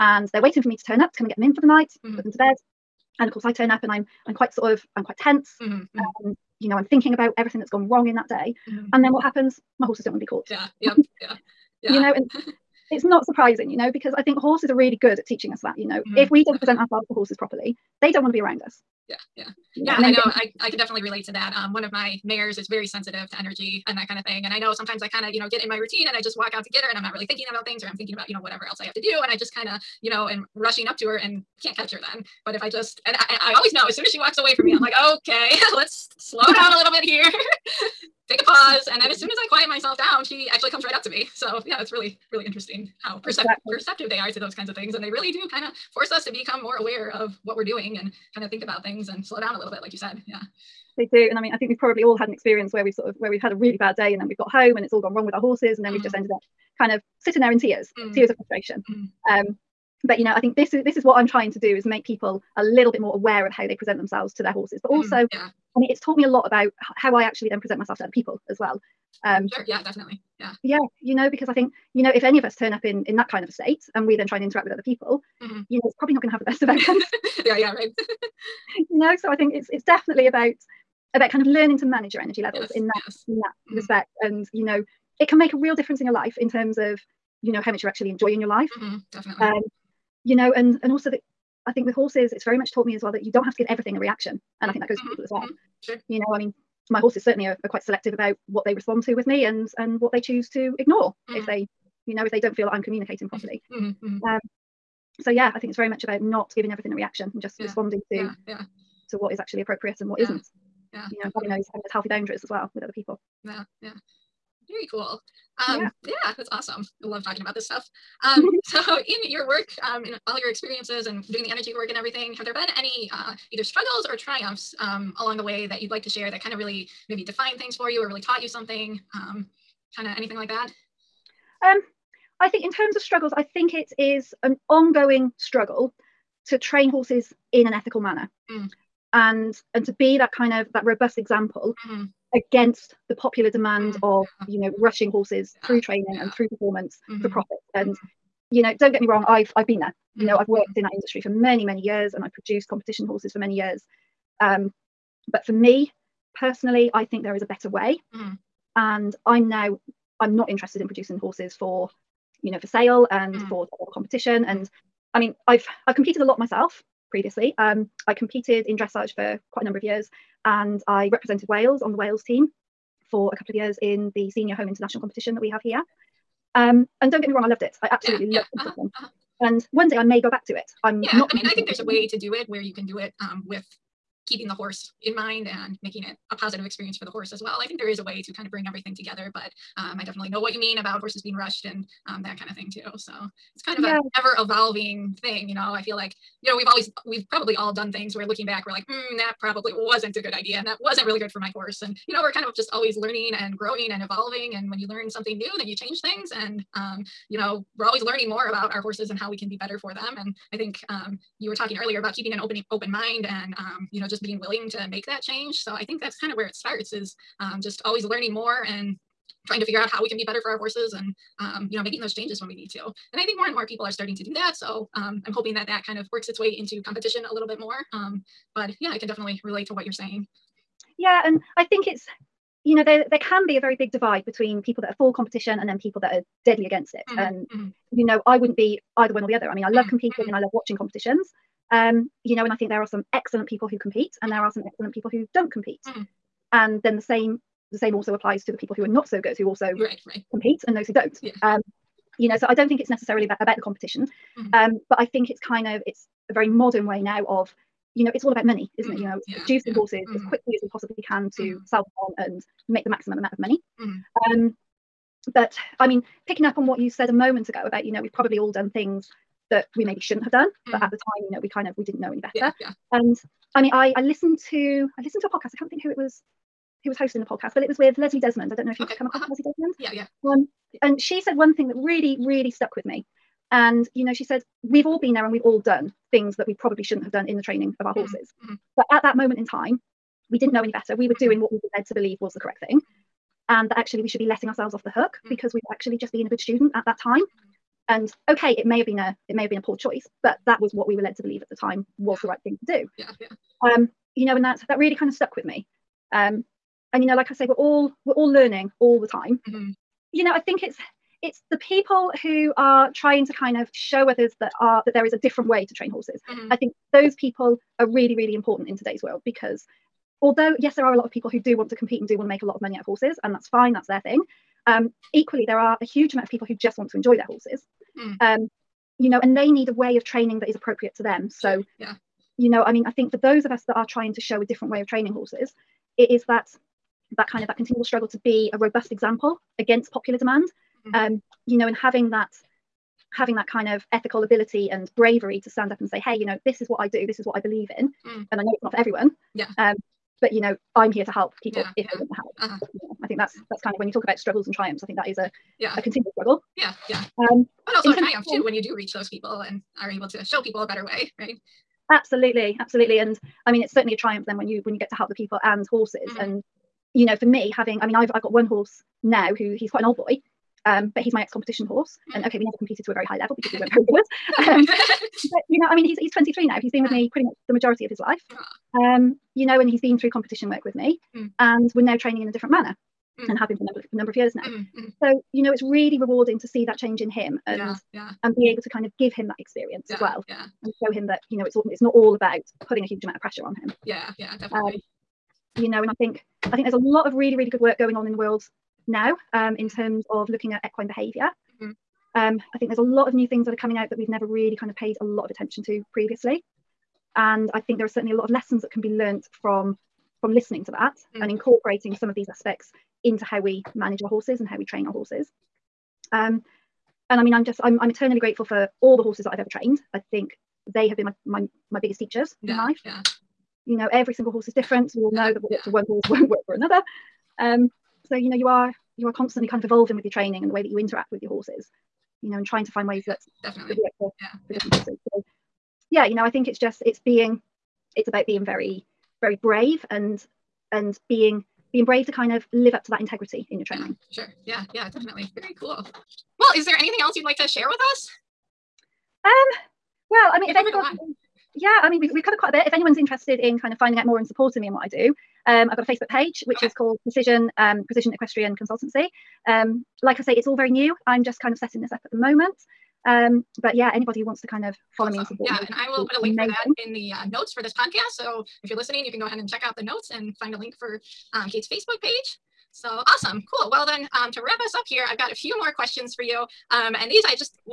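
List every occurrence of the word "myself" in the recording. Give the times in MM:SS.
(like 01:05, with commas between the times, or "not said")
00:39, 01:07, 02:46.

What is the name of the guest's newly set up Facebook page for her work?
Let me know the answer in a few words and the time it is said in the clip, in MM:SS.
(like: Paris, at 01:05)
Precision Equestrian Consultancy, at 07:37.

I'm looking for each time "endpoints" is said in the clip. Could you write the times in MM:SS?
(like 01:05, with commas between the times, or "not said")
not said.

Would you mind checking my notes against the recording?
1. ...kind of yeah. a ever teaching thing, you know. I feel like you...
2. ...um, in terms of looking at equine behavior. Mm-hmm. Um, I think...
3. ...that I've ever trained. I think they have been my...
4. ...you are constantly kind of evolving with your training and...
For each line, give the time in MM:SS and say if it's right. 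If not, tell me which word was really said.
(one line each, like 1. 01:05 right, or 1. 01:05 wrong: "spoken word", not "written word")
1. 03:13 wrong: "evolving", not "teaching"
2. 06:39 right
3. 06:59 right
4. 07:08 right.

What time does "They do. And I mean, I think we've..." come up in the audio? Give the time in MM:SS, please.
00:50.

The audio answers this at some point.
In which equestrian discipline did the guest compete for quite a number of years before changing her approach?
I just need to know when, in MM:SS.
02:48.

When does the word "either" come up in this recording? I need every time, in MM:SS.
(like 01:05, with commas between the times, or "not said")
02:03, 03:58.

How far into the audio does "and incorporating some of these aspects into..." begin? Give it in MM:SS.
06:51.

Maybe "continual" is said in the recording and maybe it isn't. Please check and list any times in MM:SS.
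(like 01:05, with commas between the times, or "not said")
05:37, 05:55.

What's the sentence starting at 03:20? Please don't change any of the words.
And that wasn't really good for my horse.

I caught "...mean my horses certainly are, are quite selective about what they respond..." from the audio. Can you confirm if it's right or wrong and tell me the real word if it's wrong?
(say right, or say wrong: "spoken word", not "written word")
right.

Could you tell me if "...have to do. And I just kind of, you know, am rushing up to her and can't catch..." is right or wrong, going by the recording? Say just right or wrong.
right.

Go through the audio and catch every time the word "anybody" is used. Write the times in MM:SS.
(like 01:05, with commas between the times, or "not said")
07:30, 07:43.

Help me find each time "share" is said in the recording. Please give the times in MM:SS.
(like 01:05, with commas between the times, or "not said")
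02:06, 07:27.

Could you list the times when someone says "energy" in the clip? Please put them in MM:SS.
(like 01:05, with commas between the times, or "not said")
00:23, 01:22, 02:01.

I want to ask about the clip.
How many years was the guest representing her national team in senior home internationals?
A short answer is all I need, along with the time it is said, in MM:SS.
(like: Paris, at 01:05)
A couple of years, at 02:53.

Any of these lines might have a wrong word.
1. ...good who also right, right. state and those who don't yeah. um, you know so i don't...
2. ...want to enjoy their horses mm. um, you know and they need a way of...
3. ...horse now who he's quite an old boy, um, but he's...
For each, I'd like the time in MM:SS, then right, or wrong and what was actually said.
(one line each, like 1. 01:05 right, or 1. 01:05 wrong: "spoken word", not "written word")
1. 04:09 wrong: "compete", not "state"
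2. 05:26 right
3. 06:08 right.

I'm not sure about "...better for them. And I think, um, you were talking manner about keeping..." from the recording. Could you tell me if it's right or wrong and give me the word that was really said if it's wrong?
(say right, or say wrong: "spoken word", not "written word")
wrong: "earlier", not "manner".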